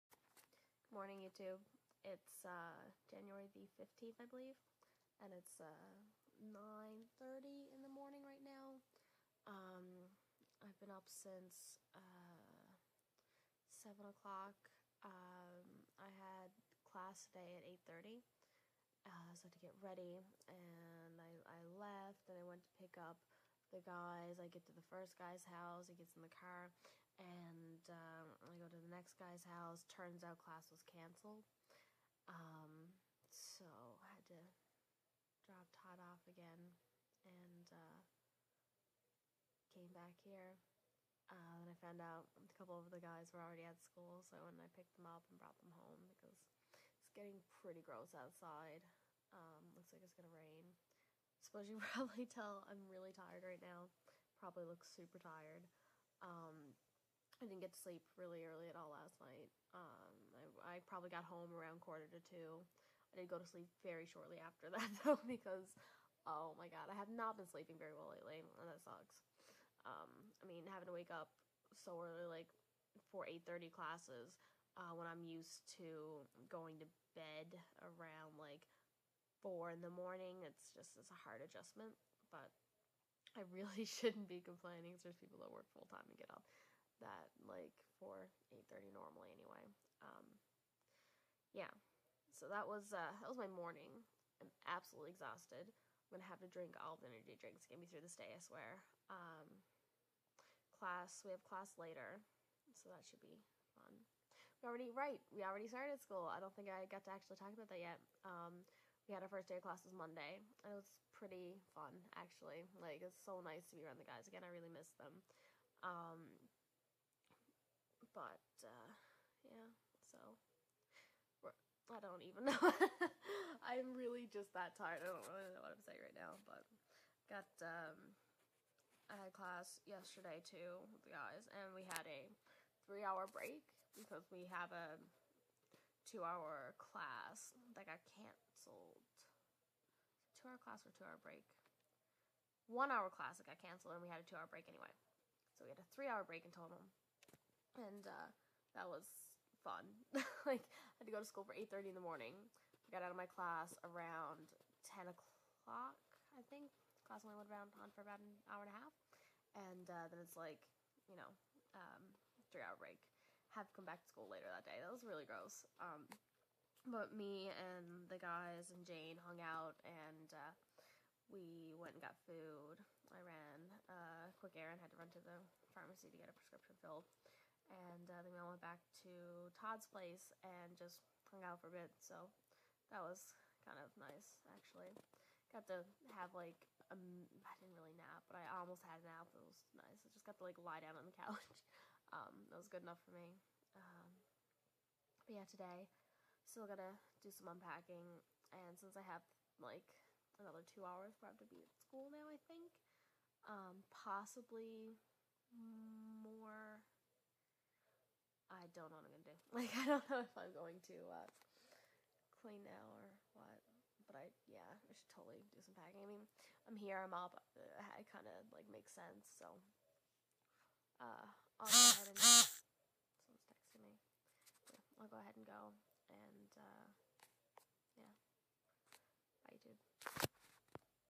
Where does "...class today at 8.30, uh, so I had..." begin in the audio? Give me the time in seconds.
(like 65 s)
16 s.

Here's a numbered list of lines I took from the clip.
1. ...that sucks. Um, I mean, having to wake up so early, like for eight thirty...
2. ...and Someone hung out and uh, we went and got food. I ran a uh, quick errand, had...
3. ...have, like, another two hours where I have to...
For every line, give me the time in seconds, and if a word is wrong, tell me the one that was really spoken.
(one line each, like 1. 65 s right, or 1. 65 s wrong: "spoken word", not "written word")
1. 68 s right
2. 168 s wrong: "Jane", not "Someone"
3. 199 s right.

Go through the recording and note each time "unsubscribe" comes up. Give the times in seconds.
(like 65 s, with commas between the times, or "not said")
not said.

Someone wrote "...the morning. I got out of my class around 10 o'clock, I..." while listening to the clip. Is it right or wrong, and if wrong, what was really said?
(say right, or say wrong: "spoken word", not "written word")
right.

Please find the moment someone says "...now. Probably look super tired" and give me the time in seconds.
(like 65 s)
53 s.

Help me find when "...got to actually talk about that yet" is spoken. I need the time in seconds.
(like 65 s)
106 s.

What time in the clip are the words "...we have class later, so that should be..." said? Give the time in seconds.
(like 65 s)
101 s.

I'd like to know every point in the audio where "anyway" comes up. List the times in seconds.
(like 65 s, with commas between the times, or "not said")
89 s, 144 s.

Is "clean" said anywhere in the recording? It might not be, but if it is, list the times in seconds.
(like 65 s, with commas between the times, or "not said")
212 s.